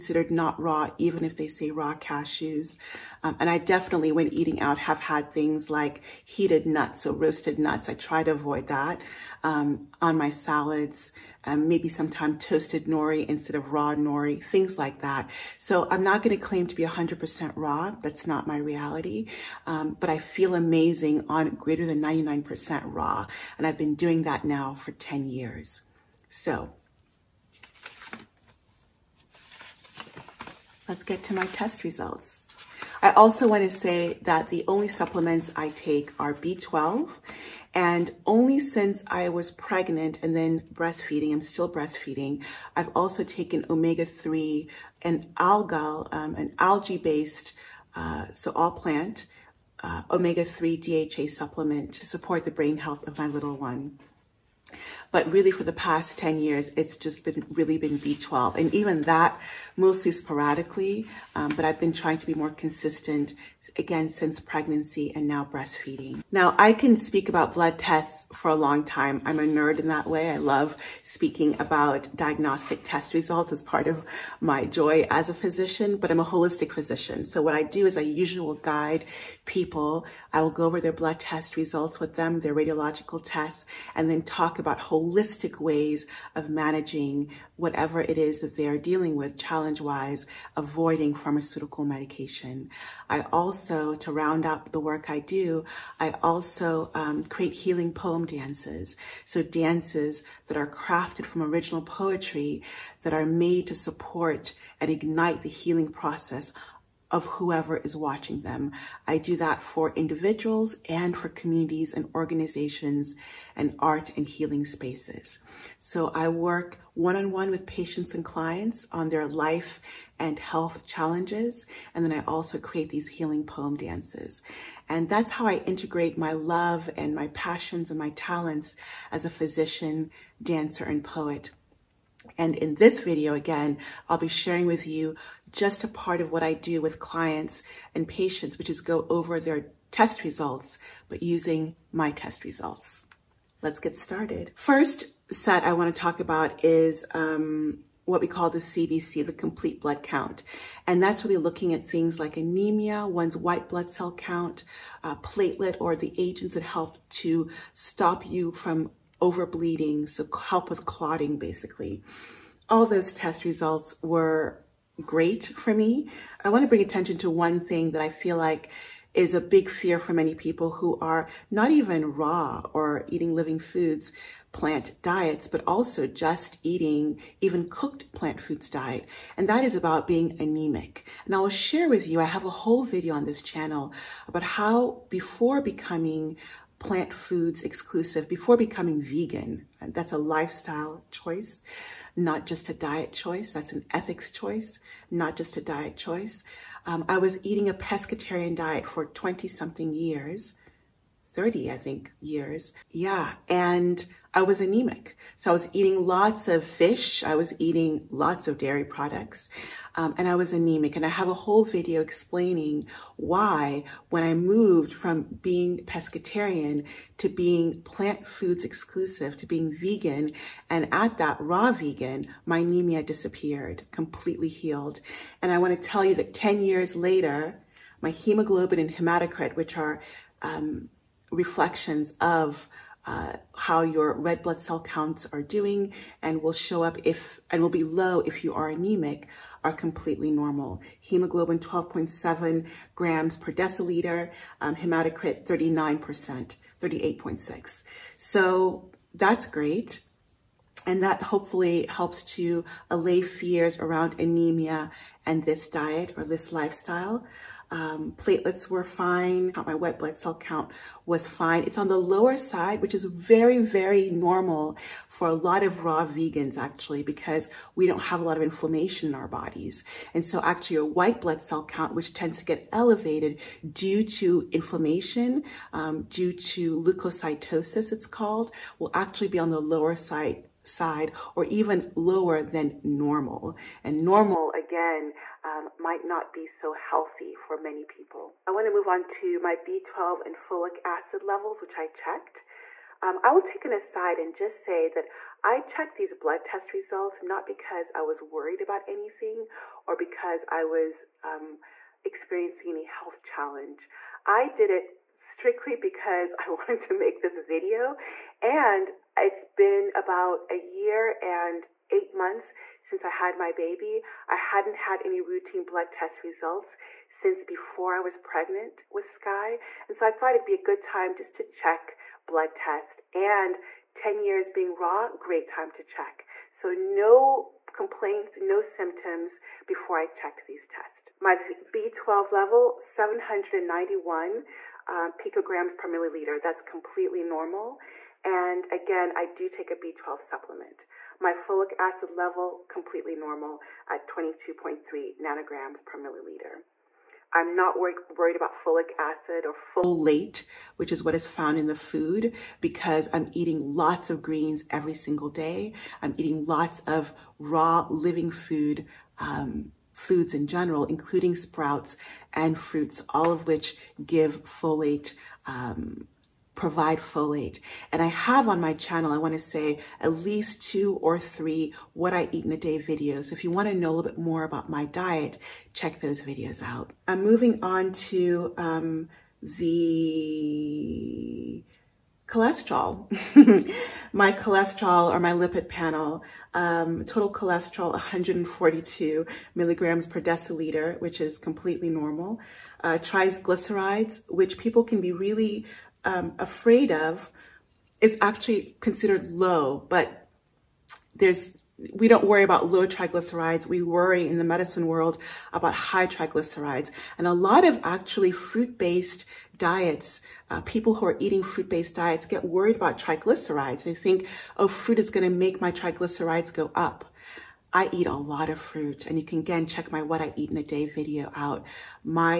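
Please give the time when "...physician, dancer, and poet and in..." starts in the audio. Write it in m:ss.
2:09.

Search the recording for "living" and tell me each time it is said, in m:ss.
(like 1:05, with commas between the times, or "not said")
2:53, 5:57.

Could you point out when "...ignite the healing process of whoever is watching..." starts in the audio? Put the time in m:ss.
1:44.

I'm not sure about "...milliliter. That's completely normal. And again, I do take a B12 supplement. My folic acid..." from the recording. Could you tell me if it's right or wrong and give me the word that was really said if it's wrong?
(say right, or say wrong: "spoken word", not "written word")
right.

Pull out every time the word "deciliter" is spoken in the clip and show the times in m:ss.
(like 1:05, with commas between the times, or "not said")
4:03, 6:30.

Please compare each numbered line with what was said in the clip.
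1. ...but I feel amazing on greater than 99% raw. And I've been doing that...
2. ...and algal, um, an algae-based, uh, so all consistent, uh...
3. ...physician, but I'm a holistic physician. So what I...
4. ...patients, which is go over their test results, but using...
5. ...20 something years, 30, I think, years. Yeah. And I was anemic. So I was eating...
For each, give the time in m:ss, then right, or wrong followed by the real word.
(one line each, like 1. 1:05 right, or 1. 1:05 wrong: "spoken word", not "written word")
1. 0:19 right
2. 0:45 wrong: "plant", not "consistent"
3. 1:15 right
4. 2:18 right
5. 3:19 right.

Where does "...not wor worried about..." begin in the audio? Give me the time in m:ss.
5:47.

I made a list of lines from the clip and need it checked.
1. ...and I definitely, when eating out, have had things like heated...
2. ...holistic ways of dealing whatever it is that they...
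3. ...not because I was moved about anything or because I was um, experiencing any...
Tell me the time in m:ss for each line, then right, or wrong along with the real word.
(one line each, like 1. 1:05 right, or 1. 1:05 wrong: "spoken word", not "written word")
1. 0:03 right
2. 1:24 wrong: "managing", not "dealing"
3. 4:57 wrong: "worried", not "moved".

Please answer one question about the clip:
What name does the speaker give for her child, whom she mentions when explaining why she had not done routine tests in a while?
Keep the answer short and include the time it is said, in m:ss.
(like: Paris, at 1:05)
Sky, at 5:19.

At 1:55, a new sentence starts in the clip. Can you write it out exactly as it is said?
So I work one-on-one -on -one with patients and clients on their life and health challenges.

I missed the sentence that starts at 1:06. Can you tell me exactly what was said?
Now I can speak about blood tests for a long time.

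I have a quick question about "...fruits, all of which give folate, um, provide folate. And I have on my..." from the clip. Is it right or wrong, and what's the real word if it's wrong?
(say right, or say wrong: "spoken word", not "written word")
right.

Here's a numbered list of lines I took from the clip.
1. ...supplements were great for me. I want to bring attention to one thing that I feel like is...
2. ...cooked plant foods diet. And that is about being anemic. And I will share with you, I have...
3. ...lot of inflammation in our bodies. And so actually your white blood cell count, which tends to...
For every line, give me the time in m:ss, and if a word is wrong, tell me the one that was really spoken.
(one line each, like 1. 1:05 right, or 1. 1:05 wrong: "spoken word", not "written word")
1. 2:43 wrong: "results", not "supplements"
2. 2:57 right
3. 4:28 right.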